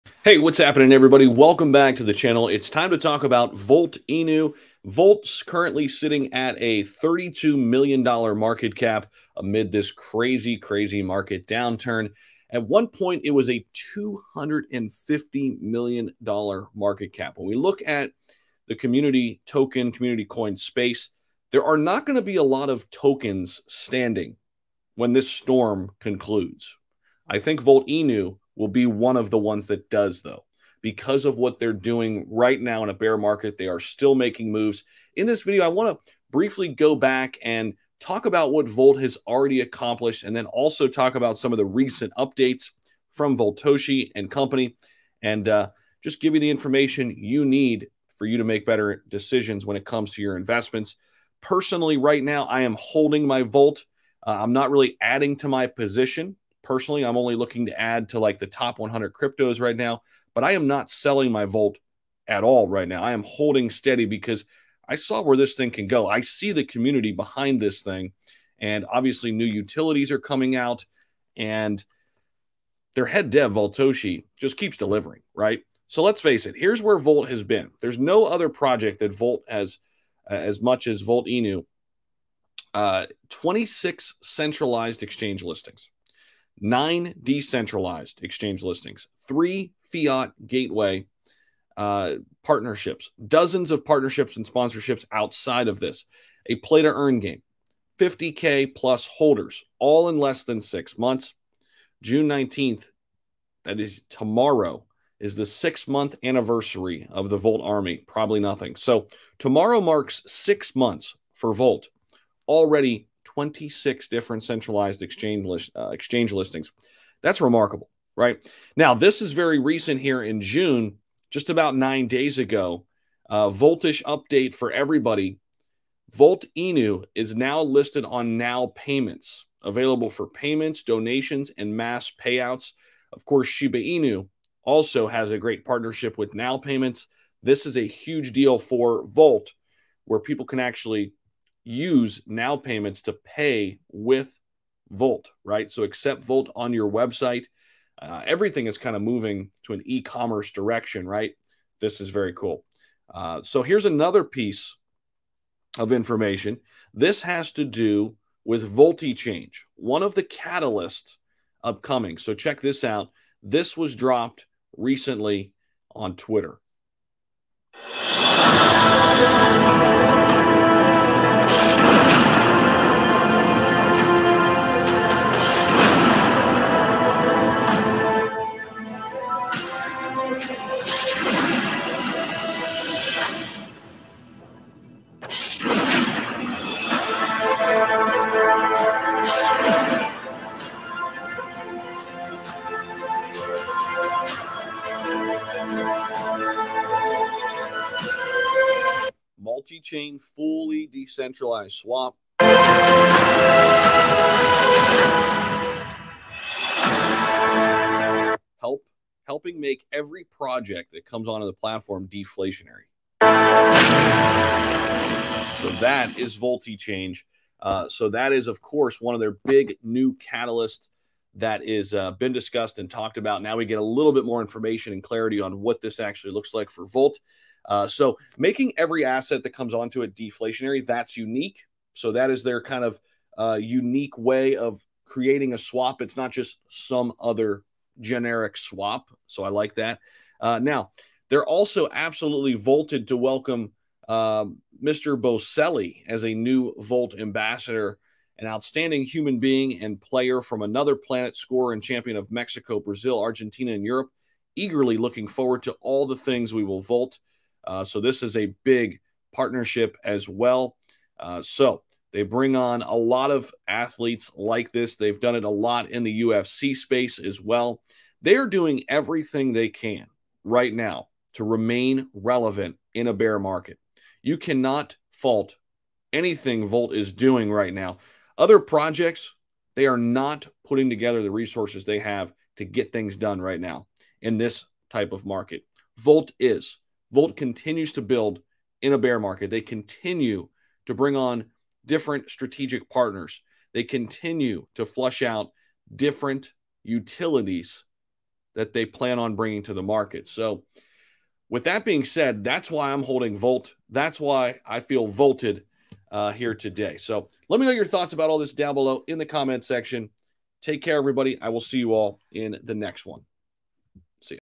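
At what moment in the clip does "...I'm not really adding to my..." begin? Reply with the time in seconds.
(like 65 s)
54 s.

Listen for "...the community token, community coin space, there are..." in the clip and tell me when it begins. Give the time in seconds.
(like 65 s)
18 s.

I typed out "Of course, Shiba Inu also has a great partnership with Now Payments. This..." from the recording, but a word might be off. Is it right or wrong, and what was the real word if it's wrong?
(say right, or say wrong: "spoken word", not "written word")
right.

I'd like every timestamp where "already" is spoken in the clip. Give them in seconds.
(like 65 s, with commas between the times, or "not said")
39 s, 112 s.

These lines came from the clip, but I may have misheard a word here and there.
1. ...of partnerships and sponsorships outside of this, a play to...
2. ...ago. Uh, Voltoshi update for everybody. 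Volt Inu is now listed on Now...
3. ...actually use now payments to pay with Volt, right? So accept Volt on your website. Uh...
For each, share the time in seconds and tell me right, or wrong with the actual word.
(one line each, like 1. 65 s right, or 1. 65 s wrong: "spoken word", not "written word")
1. 93 s right
2. 122 s right
3. 140 s right.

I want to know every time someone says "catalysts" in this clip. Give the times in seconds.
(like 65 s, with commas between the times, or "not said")
160 s, 220 s.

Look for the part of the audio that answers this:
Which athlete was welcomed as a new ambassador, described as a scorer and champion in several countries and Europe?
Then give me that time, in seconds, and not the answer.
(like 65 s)
245 s.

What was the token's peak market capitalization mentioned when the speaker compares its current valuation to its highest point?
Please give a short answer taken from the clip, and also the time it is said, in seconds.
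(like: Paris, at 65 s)
$250 million, at 13 s.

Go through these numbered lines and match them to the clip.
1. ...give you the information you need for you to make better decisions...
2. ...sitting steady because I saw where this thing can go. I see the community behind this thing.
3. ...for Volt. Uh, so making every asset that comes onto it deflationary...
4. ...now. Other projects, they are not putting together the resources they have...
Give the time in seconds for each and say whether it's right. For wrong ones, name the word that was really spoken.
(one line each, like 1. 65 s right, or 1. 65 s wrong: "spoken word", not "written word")
1. 46 s right
2. 63 s wrong: "holding", not "sitting"
3. 226 s right
4. 277 s right.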